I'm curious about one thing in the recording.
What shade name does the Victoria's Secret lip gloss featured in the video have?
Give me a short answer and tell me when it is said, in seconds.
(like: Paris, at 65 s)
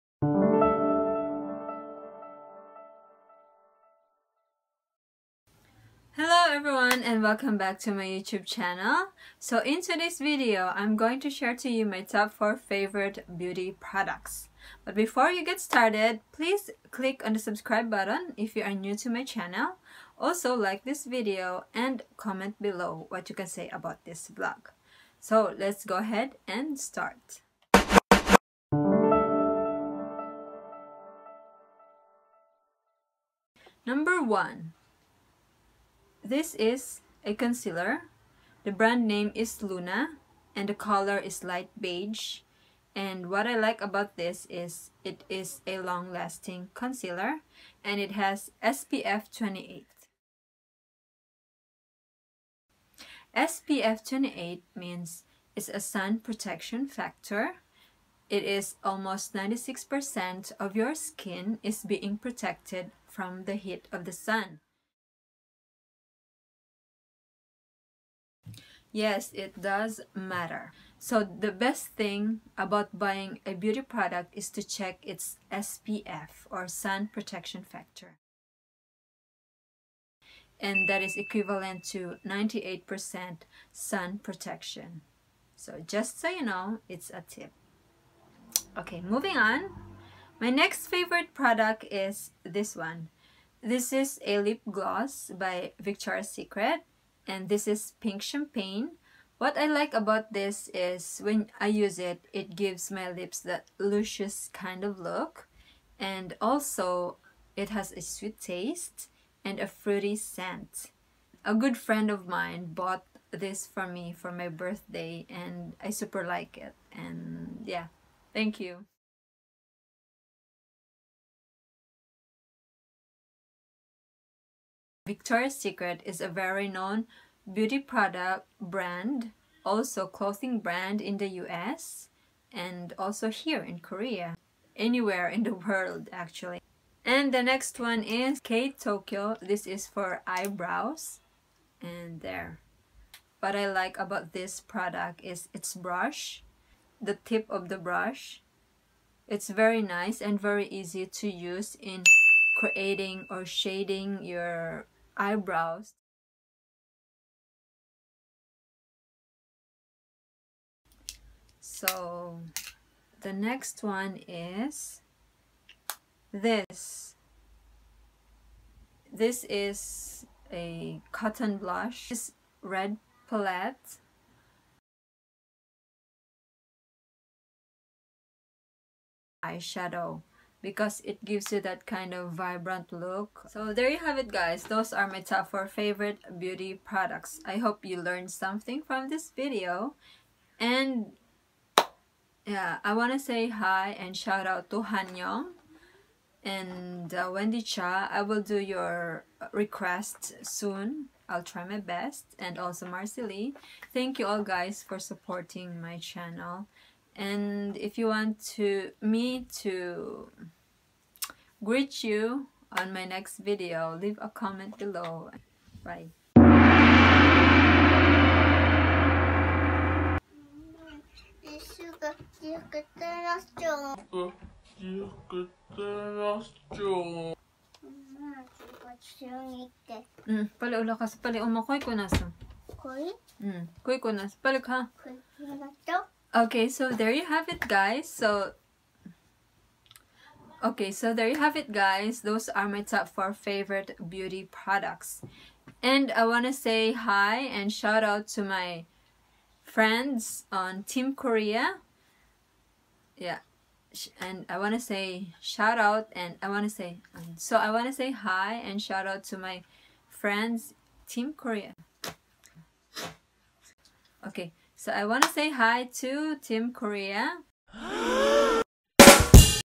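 Pink champagne, at 97 s.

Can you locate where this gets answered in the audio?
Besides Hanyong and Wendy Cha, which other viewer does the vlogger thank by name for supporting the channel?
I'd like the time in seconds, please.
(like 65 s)
202 s.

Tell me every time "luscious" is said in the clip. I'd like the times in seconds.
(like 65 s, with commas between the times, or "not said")
103 s.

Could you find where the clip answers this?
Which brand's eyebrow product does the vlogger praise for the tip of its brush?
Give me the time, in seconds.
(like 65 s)
138 s.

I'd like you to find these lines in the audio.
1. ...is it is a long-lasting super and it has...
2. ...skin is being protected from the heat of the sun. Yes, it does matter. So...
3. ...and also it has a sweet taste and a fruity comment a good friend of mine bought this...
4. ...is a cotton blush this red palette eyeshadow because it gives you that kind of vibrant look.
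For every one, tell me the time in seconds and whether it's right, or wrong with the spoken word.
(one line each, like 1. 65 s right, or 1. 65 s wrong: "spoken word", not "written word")
1. 44 s wrong: "concealer", not "super"
2. 60 s right
3. 105 s wrong: "scent", not "comment"
4. 169 s right.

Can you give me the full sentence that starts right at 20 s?
Also like this video and comment below what you can say about this vlog.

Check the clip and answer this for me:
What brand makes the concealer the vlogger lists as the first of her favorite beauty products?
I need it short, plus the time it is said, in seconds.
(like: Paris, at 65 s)
Luna, at 39 s.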